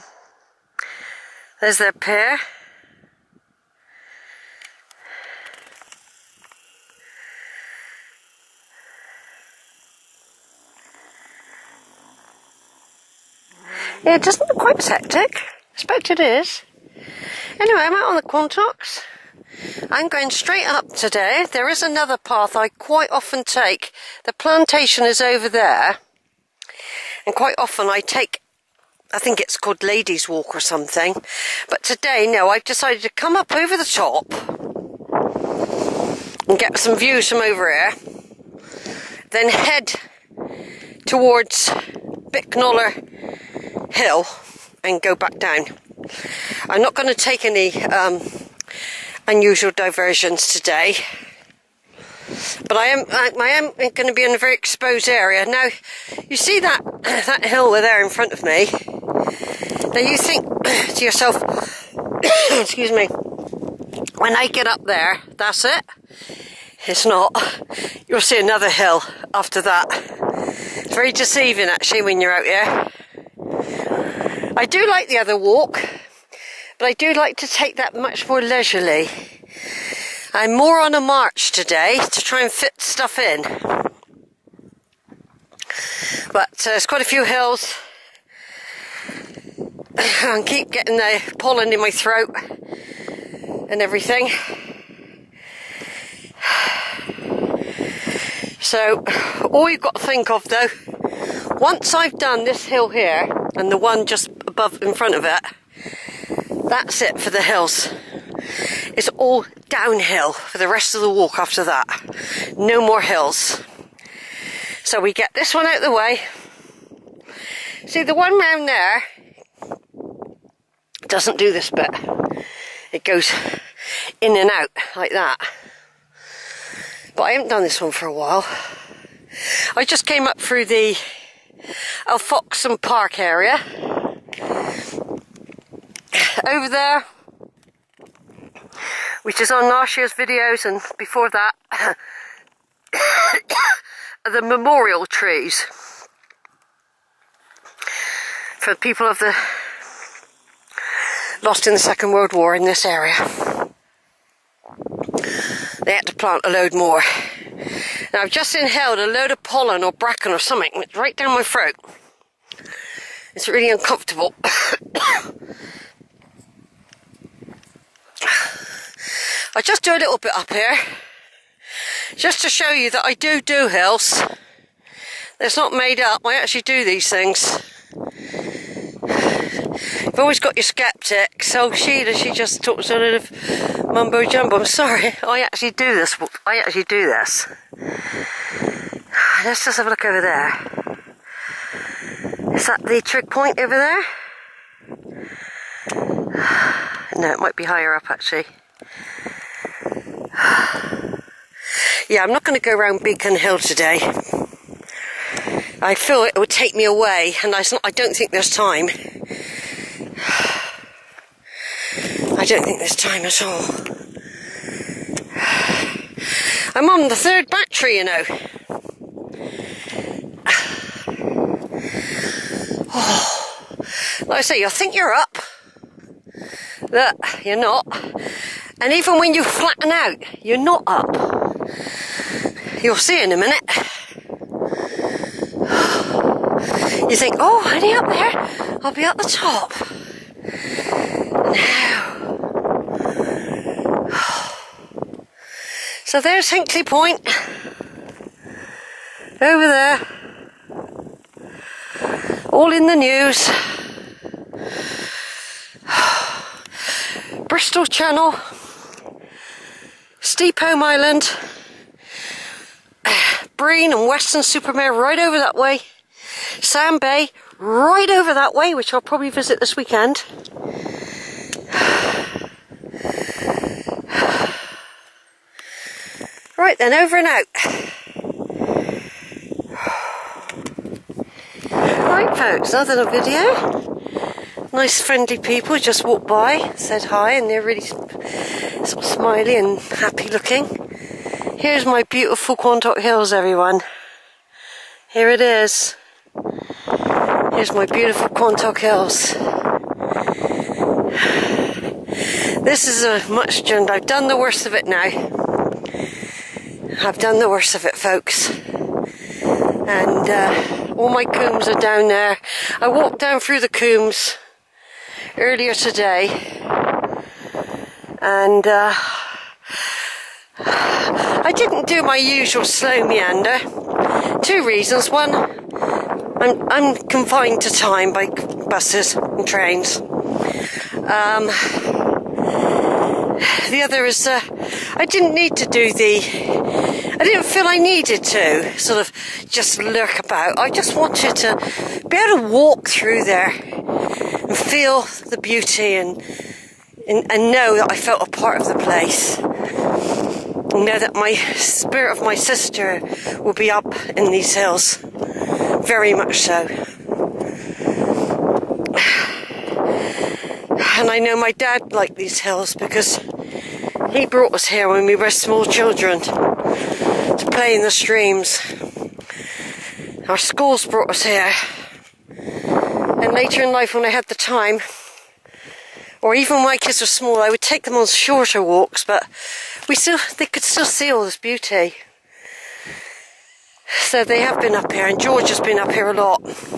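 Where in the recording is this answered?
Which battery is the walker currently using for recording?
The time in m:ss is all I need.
3:37.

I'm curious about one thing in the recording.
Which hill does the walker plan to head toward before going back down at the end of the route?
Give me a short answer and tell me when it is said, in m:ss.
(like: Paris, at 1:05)
Bicknoller Hill, at 0:42.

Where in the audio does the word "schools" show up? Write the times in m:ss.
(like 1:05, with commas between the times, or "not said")
6:10.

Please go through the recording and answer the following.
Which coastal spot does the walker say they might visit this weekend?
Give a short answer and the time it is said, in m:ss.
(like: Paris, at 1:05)
Sand Bay, at 4:26.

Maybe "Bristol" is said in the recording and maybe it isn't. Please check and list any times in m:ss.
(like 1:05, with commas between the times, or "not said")
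4:17.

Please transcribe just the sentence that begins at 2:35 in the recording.
They had to plant a load more.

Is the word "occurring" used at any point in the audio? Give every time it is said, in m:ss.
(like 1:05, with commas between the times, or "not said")
not said.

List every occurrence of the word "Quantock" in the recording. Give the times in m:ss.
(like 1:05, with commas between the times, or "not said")
0:18, 4:52, 4:58.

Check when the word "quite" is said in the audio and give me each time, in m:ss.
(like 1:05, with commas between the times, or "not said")
0:14, 0:22, 0:27, 1:26.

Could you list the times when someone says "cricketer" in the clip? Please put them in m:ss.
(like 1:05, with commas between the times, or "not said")
not said.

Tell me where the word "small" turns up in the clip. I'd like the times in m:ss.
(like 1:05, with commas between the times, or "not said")
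6:05, 6:17.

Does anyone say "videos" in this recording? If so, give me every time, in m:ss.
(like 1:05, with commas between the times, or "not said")
2:20, 4:43.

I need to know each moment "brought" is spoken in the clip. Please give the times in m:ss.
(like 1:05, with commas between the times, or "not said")
6:04, 6:10.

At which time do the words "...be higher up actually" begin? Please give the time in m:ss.
3:17.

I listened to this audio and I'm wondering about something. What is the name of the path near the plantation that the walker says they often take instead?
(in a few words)
Ladies Walk.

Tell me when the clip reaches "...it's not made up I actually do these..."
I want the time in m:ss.
2:55.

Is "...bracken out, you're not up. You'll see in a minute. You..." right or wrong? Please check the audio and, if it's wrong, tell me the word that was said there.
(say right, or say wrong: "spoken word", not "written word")
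wrong: "flatten", not "bracken".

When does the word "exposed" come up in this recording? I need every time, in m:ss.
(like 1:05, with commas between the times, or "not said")
0:54.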